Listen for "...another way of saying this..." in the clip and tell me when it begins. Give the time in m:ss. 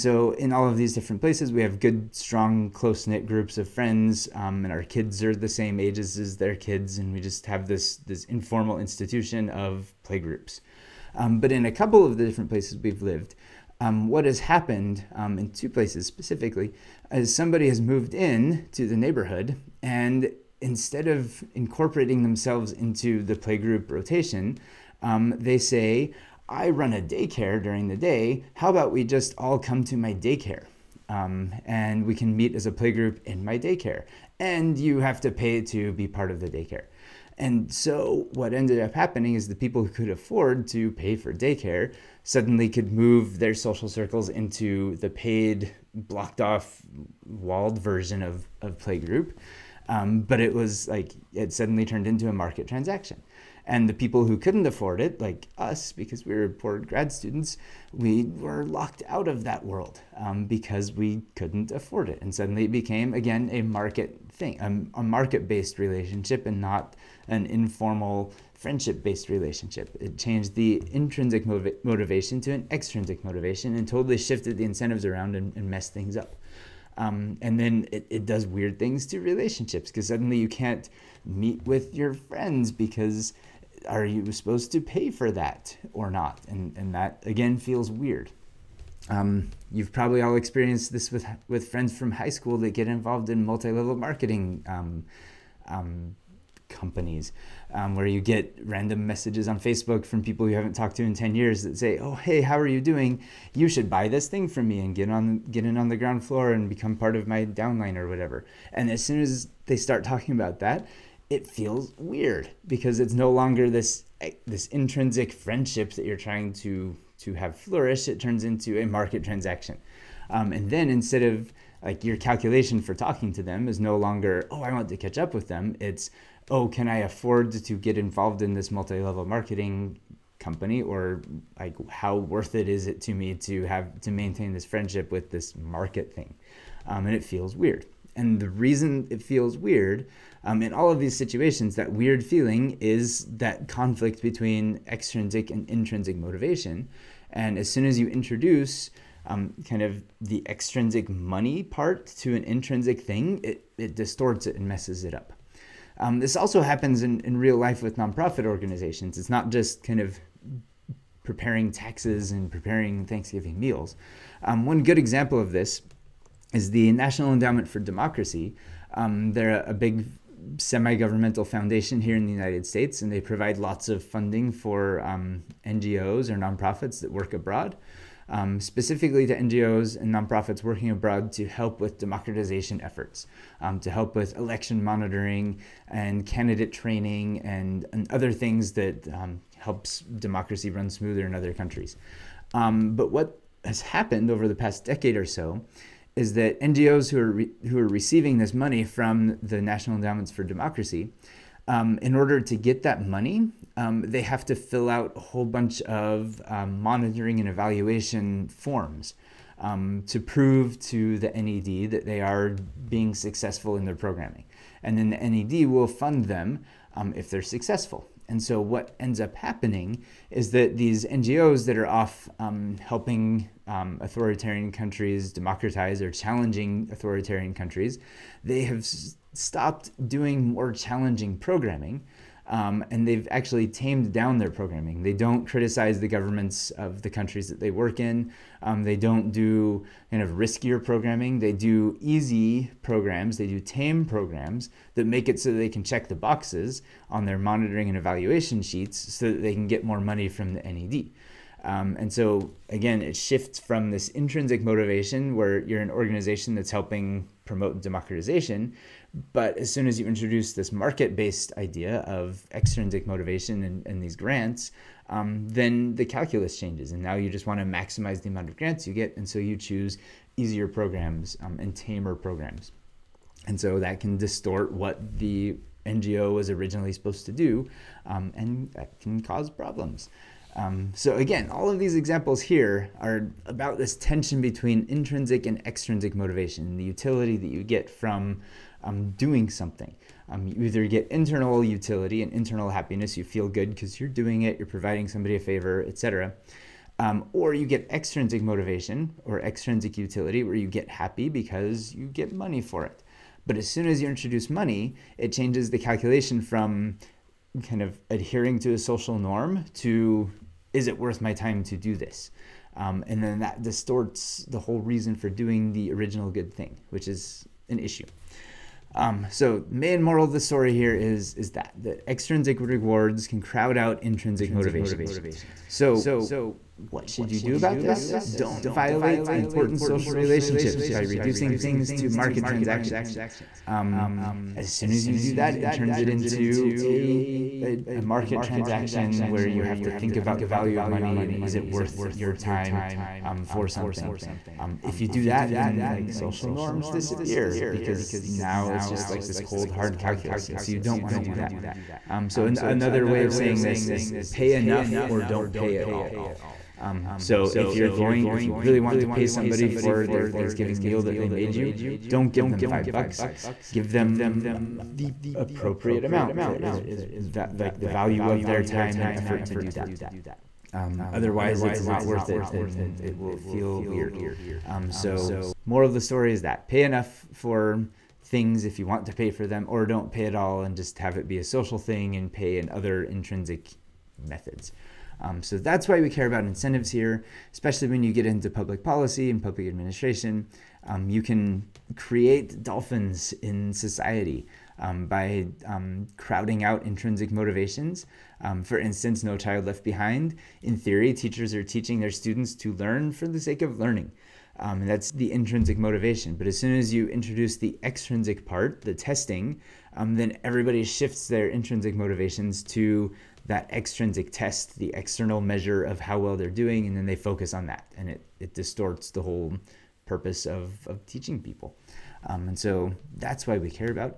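5:52.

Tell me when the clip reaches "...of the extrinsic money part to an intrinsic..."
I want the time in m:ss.
2:29.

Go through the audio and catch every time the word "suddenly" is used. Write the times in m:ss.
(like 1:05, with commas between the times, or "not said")
0:42, 0:51, 1:02, 1:20.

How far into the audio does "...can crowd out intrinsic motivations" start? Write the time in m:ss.
5:23.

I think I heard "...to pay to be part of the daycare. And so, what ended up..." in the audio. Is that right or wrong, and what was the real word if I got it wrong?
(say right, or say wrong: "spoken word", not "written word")
right.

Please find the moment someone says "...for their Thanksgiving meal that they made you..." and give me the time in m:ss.
5:59.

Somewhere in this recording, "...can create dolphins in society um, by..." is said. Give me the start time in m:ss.
6:31.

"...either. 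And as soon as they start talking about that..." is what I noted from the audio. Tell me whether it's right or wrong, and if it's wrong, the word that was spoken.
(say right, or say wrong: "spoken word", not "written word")
wrong: "whatever", not "either".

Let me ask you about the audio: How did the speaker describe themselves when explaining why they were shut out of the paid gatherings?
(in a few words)
poor grad students.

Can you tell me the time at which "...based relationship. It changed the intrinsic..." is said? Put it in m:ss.
1:09.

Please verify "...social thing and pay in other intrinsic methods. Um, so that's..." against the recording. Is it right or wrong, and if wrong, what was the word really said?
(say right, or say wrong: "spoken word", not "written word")
right.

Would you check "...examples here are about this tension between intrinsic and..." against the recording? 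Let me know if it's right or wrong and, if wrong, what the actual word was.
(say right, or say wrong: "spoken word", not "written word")
right.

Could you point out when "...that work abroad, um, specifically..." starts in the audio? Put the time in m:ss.
2:57.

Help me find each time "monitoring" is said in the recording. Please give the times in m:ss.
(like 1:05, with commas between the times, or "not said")
3:04, 3:26, 4:07.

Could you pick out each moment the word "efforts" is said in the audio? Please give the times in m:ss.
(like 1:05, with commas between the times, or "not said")
3:02, 6:09.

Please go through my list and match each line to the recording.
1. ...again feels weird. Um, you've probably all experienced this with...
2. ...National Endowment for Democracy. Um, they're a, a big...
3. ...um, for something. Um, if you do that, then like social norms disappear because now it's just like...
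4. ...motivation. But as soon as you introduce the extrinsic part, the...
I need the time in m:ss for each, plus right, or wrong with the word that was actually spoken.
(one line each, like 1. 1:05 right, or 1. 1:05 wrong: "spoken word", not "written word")
1. 1:27 right
2. 2:46 right
3. 5:43 right
4. 6:45 right.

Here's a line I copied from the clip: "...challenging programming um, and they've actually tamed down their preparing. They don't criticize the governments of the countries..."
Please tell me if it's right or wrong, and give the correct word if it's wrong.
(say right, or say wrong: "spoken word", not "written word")
wrong: "programming", not "preparing".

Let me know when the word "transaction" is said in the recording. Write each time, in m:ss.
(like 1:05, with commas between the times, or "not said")
0:52, 1:59, 5:32, 5:38.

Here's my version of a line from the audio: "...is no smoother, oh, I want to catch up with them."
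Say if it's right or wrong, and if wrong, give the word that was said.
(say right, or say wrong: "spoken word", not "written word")
wrong: "longer", not "smoother".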